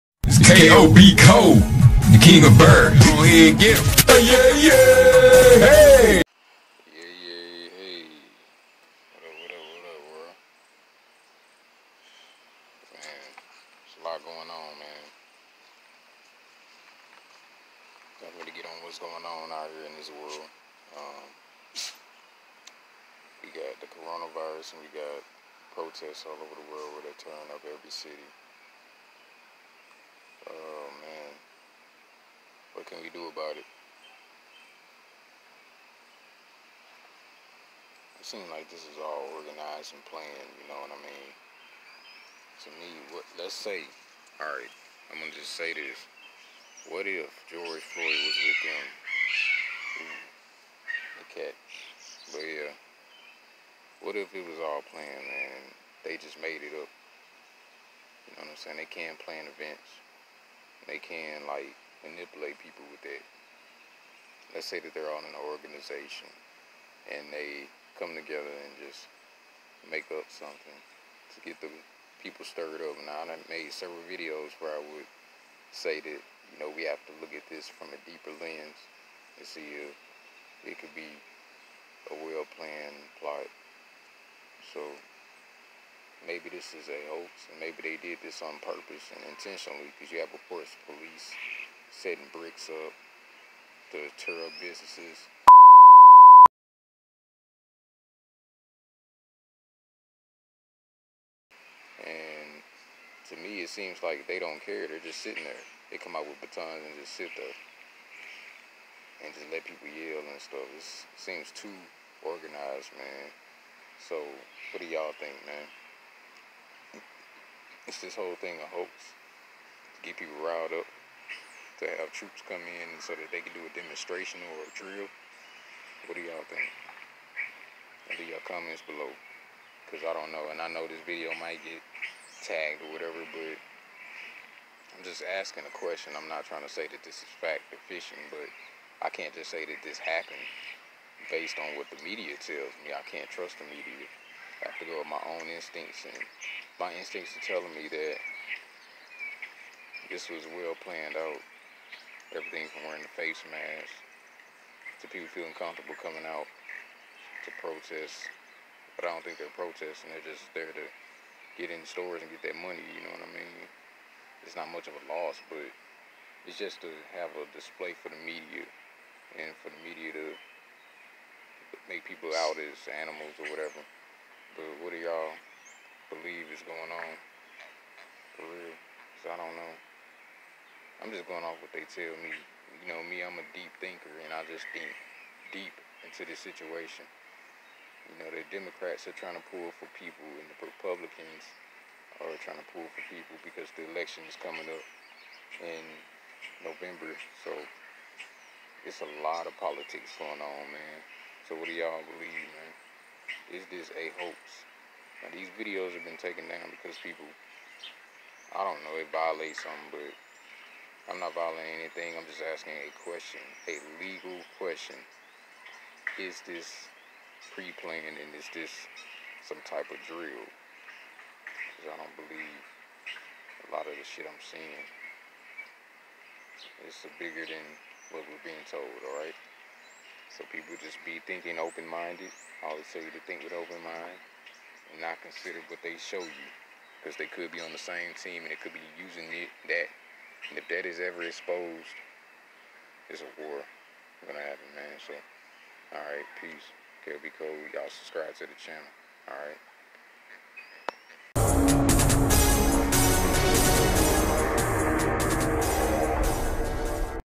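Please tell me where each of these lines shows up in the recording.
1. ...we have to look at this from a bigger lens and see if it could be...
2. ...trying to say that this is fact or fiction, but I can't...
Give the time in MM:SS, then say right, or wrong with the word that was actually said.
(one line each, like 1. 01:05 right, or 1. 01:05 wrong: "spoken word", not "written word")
1. 01:16 wrong: "deeper", not "bigger"
2. 02:16 right.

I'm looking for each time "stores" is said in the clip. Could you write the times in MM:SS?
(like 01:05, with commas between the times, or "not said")
02:41.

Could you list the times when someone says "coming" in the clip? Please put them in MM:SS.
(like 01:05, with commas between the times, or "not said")
02:35, 03:14.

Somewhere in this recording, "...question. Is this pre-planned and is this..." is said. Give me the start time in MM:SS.
03:34.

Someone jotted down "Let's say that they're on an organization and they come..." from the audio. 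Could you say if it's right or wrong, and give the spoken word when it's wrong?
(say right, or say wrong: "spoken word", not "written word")
right.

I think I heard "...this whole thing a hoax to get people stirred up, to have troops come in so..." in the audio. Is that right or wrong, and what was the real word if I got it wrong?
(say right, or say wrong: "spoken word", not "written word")
wrong: "riled", not "stirred".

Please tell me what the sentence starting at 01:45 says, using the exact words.
They come out with batons and just sit there and just let people yell and stuff.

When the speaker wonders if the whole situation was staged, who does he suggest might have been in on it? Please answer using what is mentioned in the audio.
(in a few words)
George Floyd.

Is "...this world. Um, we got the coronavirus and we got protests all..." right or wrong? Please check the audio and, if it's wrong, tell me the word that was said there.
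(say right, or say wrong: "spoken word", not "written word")
right.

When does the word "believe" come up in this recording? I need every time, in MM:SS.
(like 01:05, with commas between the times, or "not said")
02:56, 03:22, 03:42.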